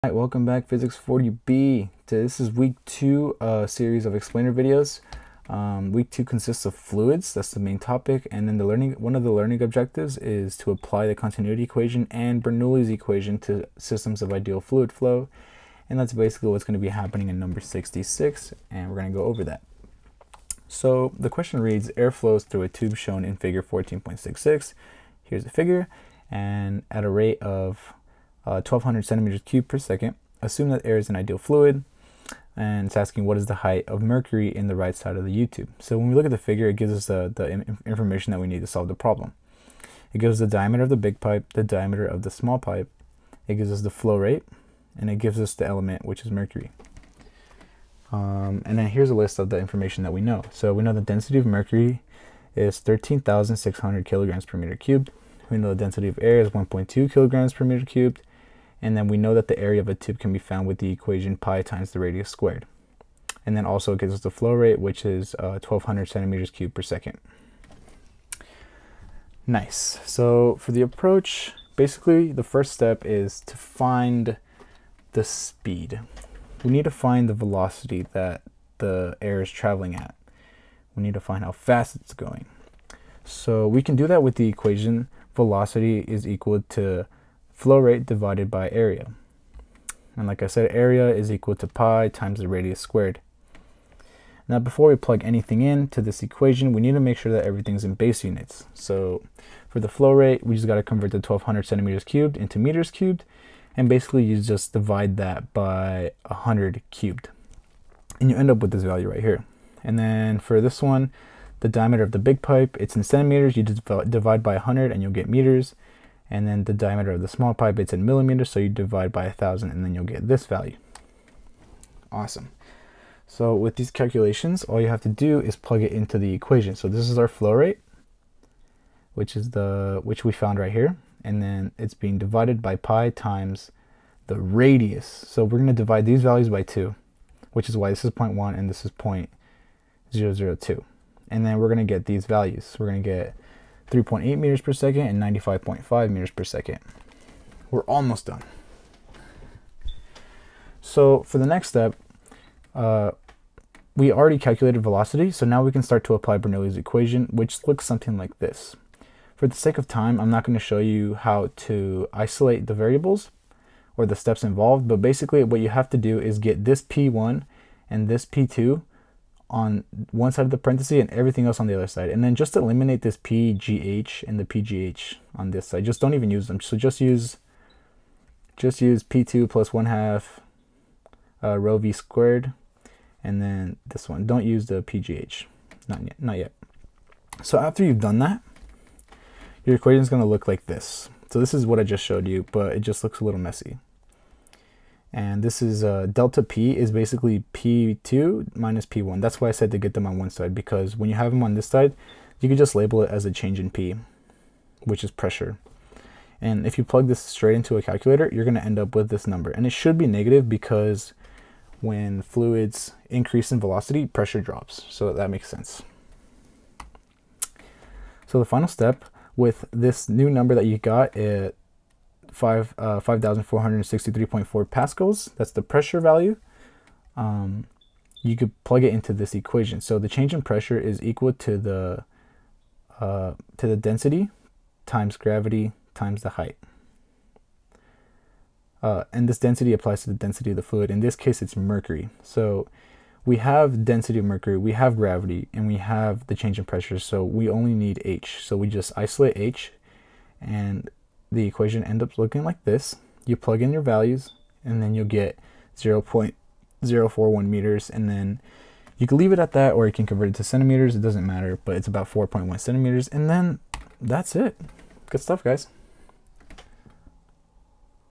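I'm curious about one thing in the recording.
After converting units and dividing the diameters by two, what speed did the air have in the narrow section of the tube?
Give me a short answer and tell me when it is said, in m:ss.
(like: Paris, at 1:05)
95.5 meters per second, at 2:25.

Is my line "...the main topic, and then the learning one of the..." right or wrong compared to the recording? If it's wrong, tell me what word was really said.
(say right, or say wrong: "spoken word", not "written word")
right.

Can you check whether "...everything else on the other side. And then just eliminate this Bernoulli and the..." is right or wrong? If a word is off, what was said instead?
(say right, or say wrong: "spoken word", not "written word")
wrong: "PGH", not "Bernoulli".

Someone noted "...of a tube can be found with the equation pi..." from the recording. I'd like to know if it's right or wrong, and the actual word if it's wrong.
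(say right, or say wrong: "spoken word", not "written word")
right.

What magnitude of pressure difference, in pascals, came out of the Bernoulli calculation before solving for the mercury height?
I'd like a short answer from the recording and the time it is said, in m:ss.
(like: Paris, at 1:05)
5,463.4 pascals, at 3:43.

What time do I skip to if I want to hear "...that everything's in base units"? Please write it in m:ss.
1:37.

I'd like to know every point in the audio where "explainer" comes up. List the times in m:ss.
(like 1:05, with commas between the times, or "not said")
0:04.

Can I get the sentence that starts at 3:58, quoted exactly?
Uh, and this density applies to the density of the fluid.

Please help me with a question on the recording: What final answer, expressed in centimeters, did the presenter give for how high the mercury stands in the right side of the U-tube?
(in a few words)
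4.1 centimeters.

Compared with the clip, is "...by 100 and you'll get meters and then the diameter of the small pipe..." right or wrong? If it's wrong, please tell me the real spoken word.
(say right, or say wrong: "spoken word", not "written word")
right.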